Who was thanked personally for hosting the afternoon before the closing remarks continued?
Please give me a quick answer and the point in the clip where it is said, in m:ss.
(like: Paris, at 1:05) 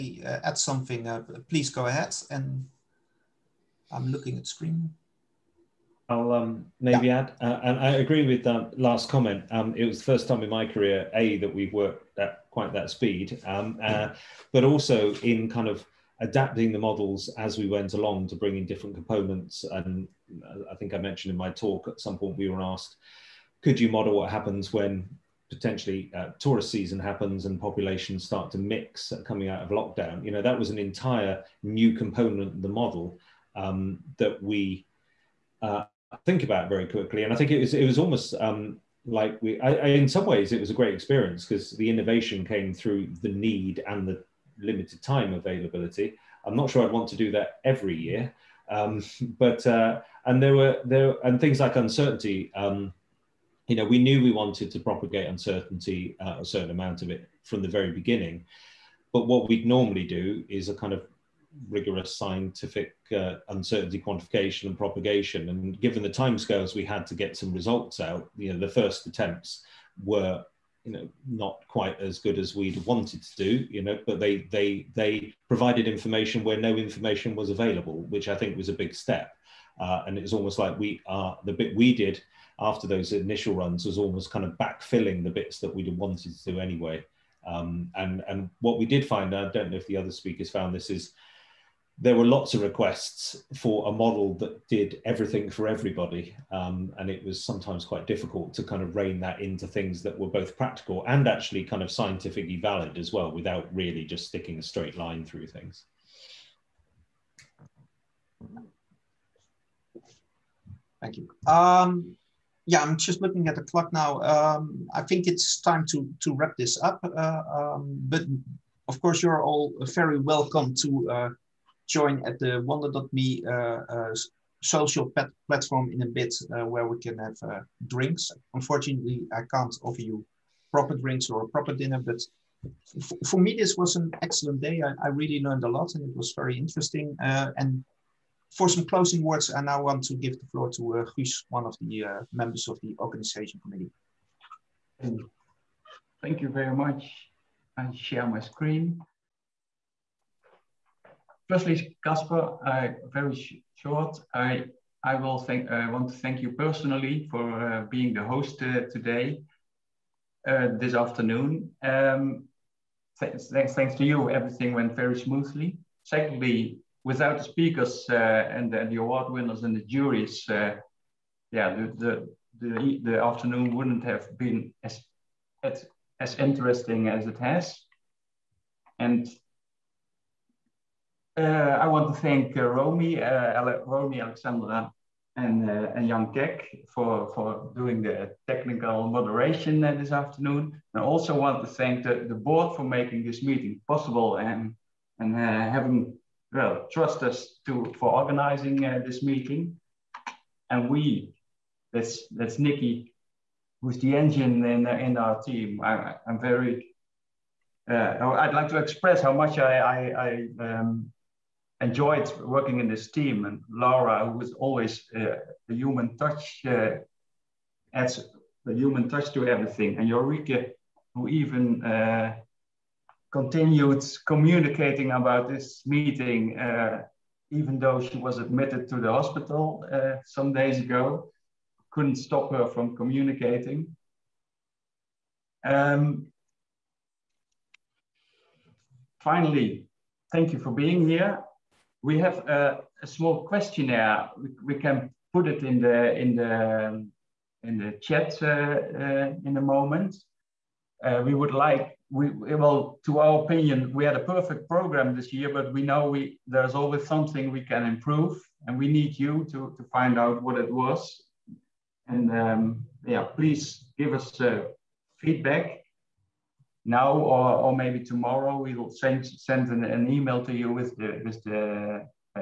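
Casper, at 2:32.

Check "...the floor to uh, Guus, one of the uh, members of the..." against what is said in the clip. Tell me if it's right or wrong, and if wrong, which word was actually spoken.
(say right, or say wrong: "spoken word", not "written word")
right.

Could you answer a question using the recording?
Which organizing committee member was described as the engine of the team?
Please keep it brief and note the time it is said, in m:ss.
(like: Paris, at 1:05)
Nikki, at 3:22.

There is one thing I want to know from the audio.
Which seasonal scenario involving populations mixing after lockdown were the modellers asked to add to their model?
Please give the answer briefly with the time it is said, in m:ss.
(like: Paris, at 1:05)
tourist season, at 0:26.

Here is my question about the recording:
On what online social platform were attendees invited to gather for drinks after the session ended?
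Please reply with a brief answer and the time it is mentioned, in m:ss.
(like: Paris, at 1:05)
Wonder.me, at 2:02.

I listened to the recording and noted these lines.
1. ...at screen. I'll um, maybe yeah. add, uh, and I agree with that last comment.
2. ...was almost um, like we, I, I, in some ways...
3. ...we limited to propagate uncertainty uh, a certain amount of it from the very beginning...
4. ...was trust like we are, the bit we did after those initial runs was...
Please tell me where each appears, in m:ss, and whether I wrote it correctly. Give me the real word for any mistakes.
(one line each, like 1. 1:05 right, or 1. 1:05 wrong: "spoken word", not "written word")
1. 0:04 right
2. 0:37 right
3. 0:54 wrong: "wanted", not "limited"
4. 1:20 wrong: "almost", not "trust".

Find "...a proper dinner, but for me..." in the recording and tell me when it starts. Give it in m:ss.
2:11.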